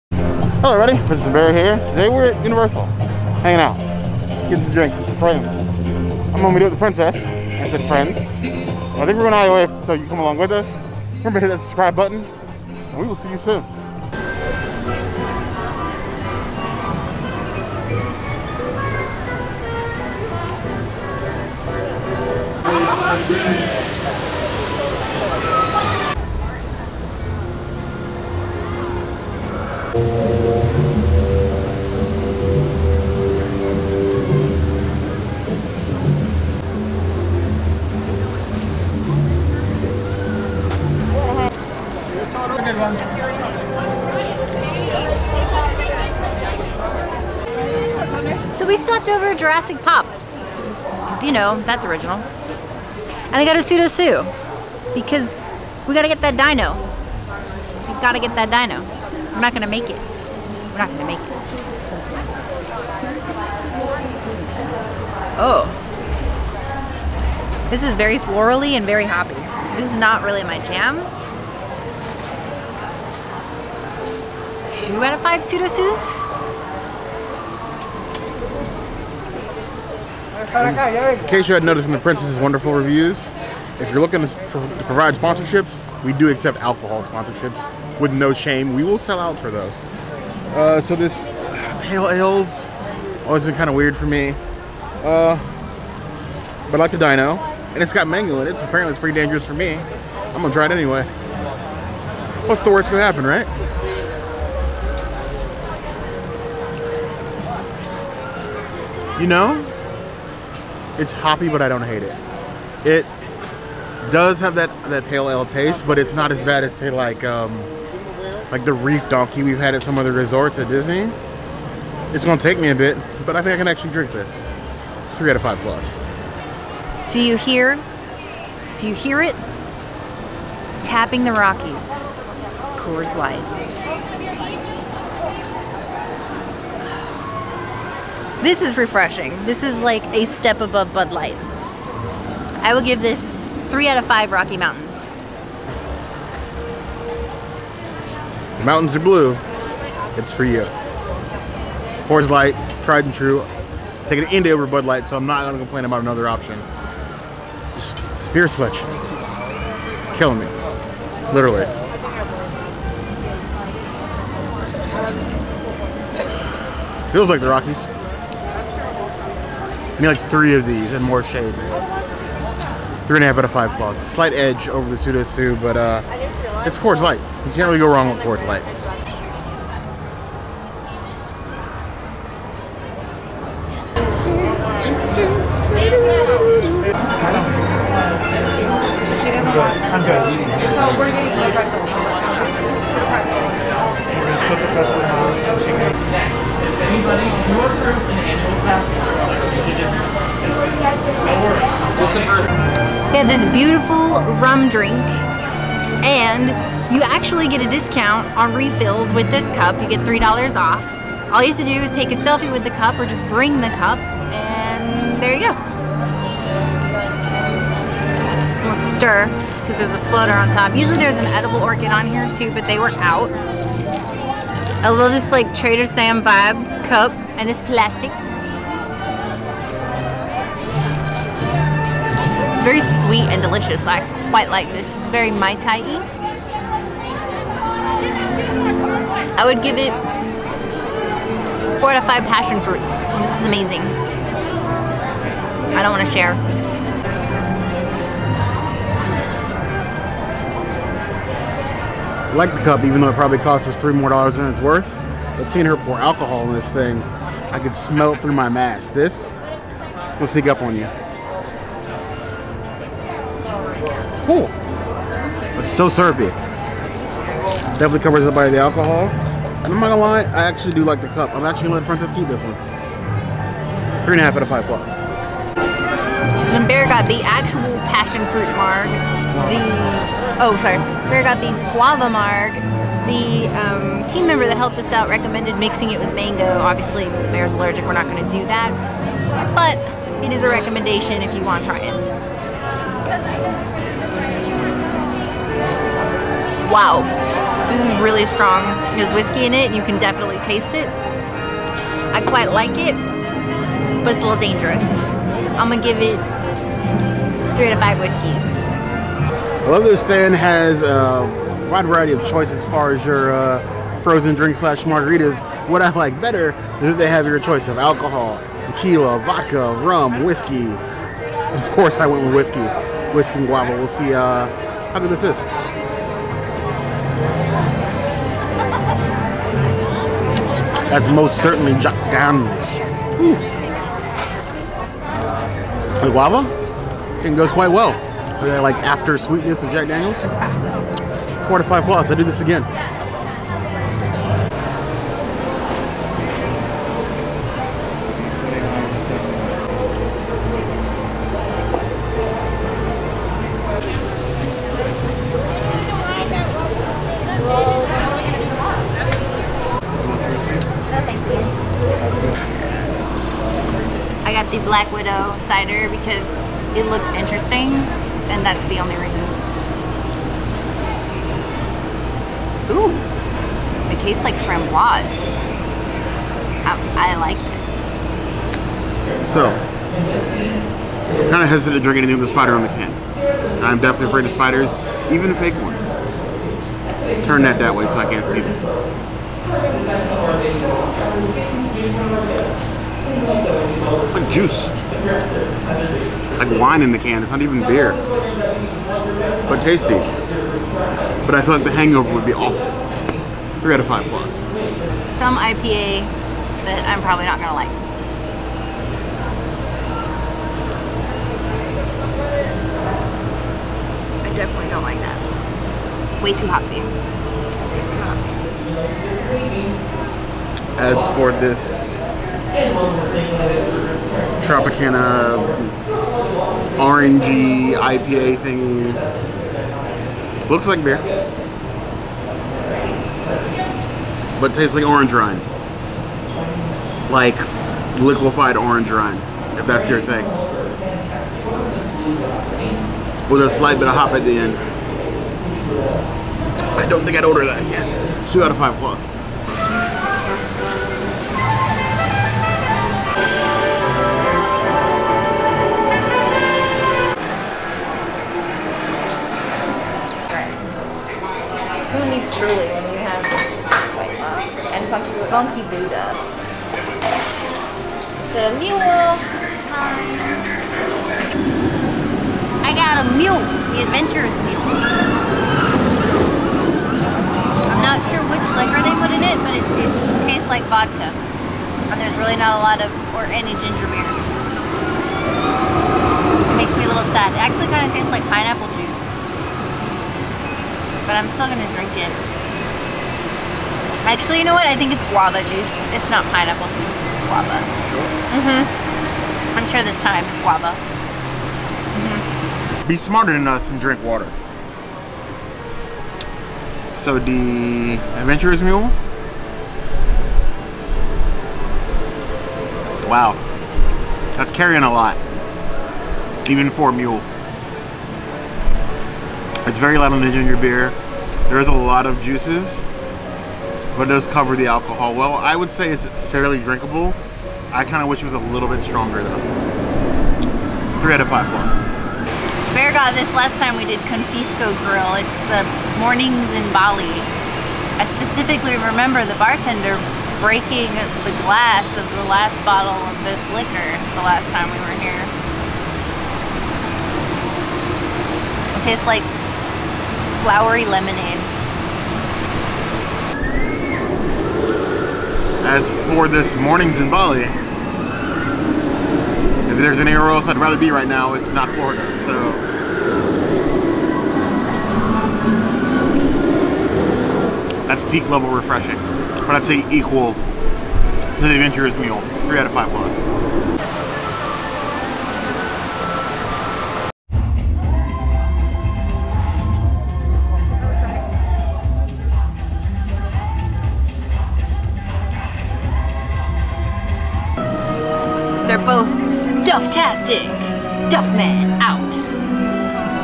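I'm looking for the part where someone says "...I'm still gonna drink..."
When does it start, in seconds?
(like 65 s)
491 s.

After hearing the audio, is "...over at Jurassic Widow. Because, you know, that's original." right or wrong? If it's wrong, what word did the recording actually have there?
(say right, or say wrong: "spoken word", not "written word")
wrong: "Pop", not "Widow".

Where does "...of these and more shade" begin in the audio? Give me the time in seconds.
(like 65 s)
170 s.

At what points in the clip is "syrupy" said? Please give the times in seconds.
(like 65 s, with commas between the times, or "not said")
265 s.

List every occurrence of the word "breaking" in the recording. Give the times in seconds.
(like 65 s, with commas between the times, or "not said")
540 s.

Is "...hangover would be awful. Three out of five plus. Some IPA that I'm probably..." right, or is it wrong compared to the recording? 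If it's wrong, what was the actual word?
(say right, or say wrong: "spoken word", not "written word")
right.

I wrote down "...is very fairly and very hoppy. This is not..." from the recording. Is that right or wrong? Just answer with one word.
wrong.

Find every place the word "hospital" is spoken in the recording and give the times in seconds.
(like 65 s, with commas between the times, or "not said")
not said.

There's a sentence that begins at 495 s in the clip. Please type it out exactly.
It's not pineapple juice, it's guava.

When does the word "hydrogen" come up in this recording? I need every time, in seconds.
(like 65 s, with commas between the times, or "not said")
not said.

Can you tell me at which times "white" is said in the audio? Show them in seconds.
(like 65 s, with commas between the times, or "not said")
463 s.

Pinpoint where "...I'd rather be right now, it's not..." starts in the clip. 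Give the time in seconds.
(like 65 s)
560 s.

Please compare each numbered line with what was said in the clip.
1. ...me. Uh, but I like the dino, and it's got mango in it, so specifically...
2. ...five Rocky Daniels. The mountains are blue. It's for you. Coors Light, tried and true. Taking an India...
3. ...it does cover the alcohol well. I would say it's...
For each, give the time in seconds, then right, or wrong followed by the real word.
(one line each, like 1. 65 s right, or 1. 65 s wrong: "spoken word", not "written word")
1. 94 s wrong: "apparently", not "specifically"
2. 144 s wrong: "Mountains", not "Daniels"
3. 524 s right.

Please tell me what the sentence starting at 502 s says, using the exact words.
Be smarter than us and drink water.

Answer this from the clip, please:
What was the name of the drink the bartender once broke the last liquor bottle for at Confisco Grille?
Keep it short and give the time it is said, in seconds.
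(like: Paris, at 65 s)
Mornings in Bali, at 536 s.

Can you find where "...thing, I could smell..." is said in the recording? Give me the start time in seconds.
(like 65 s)
256 s.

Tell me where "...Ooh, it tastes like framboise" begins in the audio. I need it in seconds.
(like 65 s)
372 s.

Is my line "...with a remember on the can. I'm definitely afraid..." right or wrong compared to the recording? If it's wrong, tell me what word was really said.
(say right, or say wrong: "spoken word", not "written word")
wrong: "spider", not "remember".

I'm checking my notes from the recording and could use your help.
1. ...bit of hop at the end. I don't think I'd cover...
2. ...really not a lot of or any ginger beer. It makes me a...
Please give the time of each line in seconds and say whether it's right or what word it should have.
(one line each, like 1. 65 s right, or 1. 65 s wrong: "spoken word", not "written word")
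1. 443 s wrong: "order", not "cover"
2. 482 s right.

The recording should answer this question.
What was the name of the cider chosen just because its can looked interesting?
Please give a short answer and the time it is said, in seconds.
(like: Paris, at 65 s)
Black Widow, at 364 s.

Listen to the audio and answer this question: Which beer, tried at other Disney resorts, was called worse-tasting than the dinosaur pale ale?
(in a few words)
Reef Donkey.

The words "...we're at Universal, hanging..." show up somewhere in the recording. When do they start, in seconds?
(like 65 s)
2 s.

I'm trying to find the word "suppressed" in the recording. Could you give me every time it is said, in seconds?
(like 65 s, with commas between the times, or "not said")
not said.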